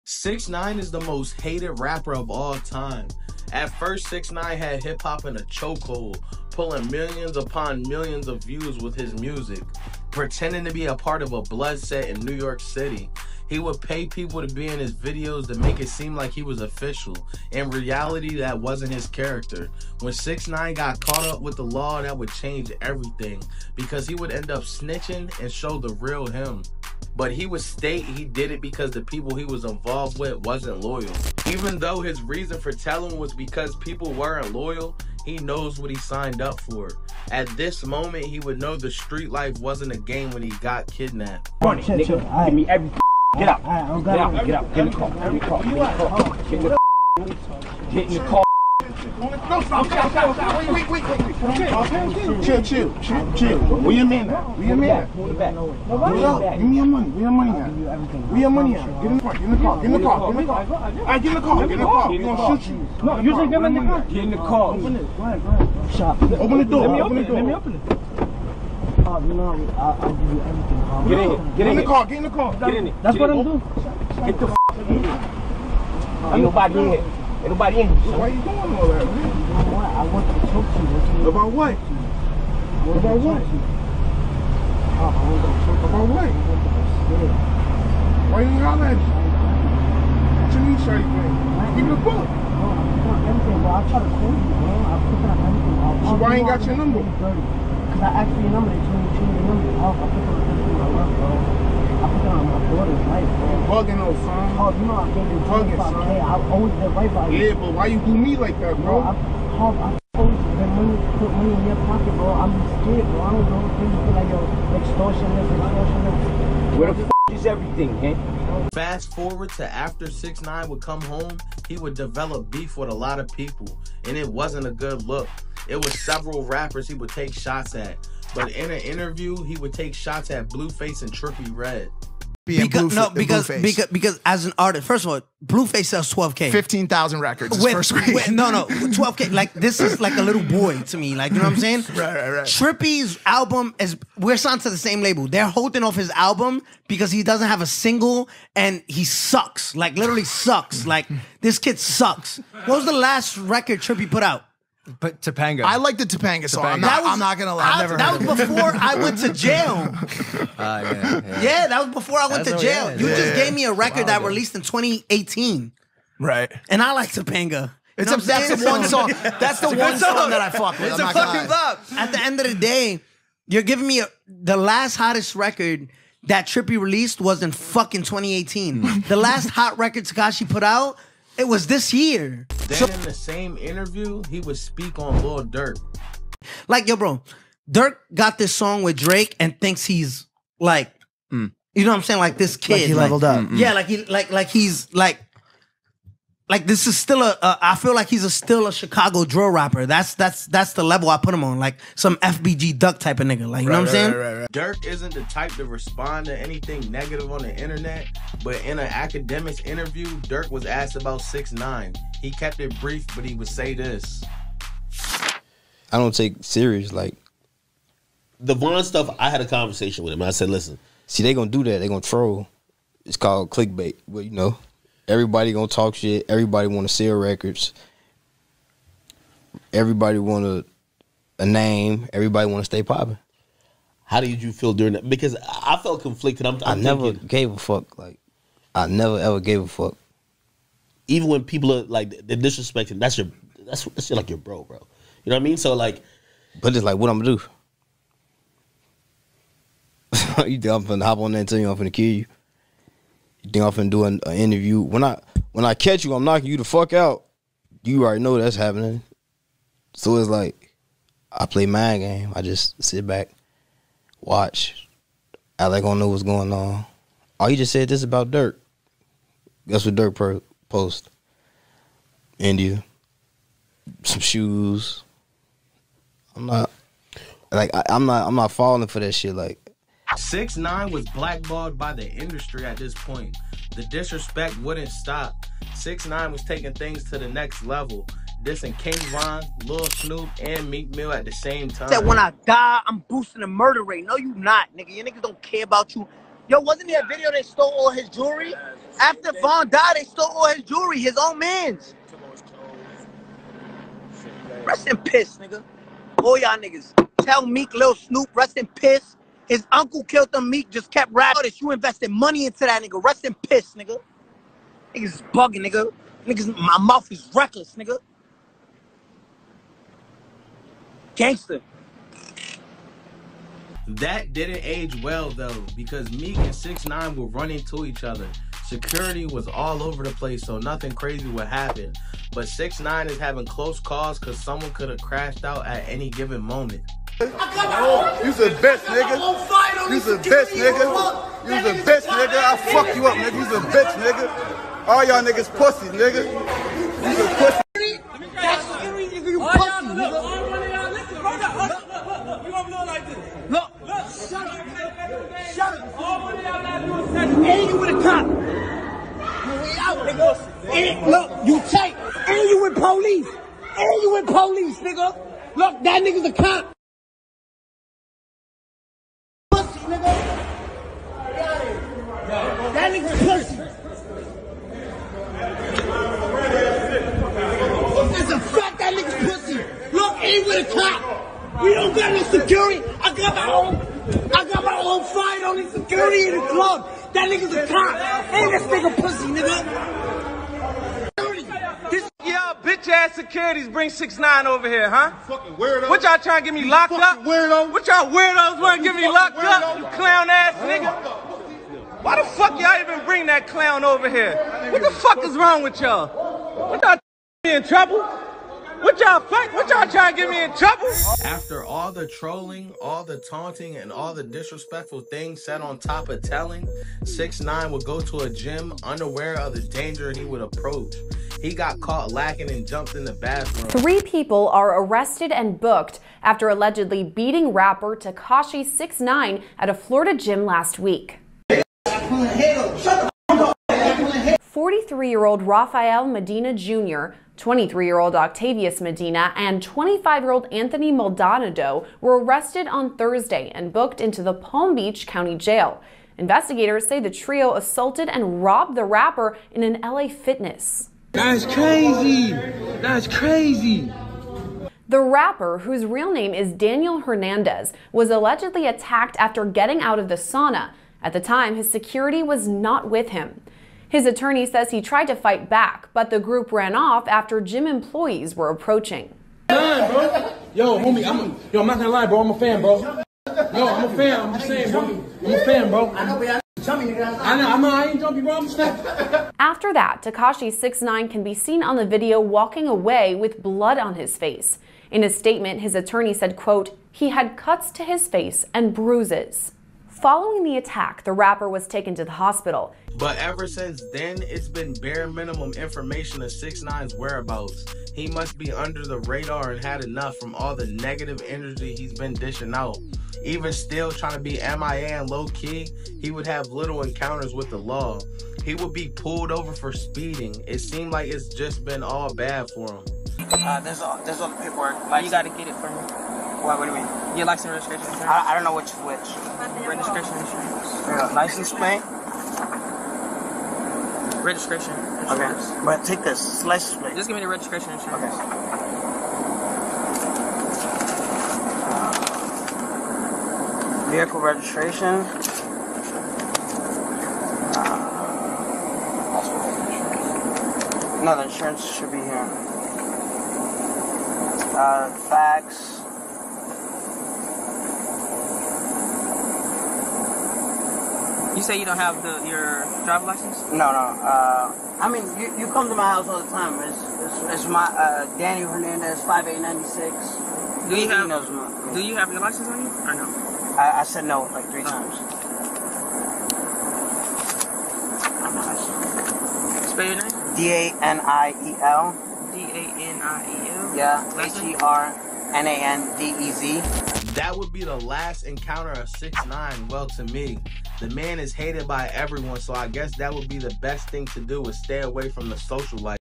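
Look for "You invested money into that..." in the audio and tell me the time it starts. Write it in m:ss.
5:11.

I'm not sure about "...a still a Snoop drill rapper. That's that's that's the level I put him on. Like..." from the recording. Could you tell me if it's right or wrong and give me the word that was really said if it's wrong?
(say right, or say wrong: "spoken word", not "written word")
wrong: "Chicago", not "Snoop".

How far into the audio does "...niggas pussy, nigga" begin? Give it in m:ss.
5:45.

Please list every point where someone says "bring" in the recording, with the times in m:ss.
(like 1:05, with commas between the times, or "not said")
6:33, 6:43.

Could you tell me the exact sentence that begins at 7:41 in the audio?
At the time, his security was not with him.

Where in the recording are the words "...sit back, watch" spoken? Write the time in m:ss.
4:22.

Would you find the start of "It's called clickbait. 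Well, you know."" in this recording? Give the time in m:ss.
3:43.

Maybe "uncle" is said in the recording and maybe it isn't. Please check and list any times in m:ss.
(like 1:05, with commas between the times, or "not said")
5:09.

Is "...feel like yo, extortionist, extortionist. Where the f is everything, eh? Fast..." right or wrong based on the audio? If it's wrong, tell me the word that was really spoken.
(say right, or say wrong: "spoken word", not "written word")
right.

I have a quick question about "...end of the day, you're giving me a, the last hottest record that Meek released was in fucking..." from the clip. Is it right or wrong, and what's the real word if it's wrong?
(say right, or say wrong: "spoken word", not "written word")
wrong: "Trippie", not "Meek".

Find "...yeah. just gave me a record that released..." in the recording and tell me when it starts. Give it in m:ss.
2:43.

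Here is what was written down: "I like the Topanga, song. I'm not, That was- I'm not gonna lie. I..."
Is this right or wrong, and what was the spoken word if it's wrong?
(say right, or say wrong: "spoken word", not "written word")
right.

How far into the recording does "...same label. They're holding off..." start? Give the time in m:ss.
2:24.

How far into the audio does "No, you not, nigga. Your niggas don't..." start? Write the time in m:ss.
4:54.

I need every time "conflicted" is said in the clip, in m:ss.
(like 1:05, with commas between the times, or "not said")
3:56.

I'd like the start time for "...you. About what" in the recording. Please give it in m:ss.
1:20.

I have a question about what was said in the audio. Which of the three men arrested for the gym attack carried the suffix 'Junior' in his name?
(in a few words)
Rafael Medina Jr.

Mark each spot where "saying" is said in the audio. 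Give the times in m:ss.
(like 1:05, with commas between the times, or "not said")
2:21, 3:12, 3:23, 7:54.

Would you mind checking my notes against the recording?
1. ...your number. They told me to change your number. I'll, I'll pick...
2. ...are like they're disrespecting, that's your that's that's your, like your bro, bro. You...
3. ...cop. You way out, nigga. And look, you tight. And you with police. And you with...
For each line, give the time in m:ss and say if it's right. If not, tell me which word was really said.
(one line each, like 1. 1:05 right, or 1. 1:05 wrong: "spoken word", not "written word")
1. 1:38 right
2. 4:01 right
3. 5:58 right.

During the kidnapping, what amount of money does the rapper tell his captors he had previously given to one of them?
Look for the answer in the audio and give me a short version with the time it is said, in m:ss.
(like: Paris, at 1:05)
25K, at 1:45.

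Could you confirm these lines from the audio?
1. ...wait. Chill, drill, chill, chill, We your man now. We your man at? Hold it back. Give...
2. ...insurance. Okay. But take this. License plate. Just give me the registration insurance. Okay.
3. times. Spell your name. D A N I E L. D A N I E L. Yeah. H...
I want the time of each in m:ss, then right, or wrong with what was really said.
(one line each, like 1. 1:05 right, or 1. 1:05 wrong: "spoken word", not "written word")
1. 0:51 wrong: "chill", not "drill"
2. 8:44 right
3. 9:24 right.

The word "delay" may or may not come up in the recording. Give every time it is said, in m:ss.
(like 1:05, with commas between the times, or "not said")
not said.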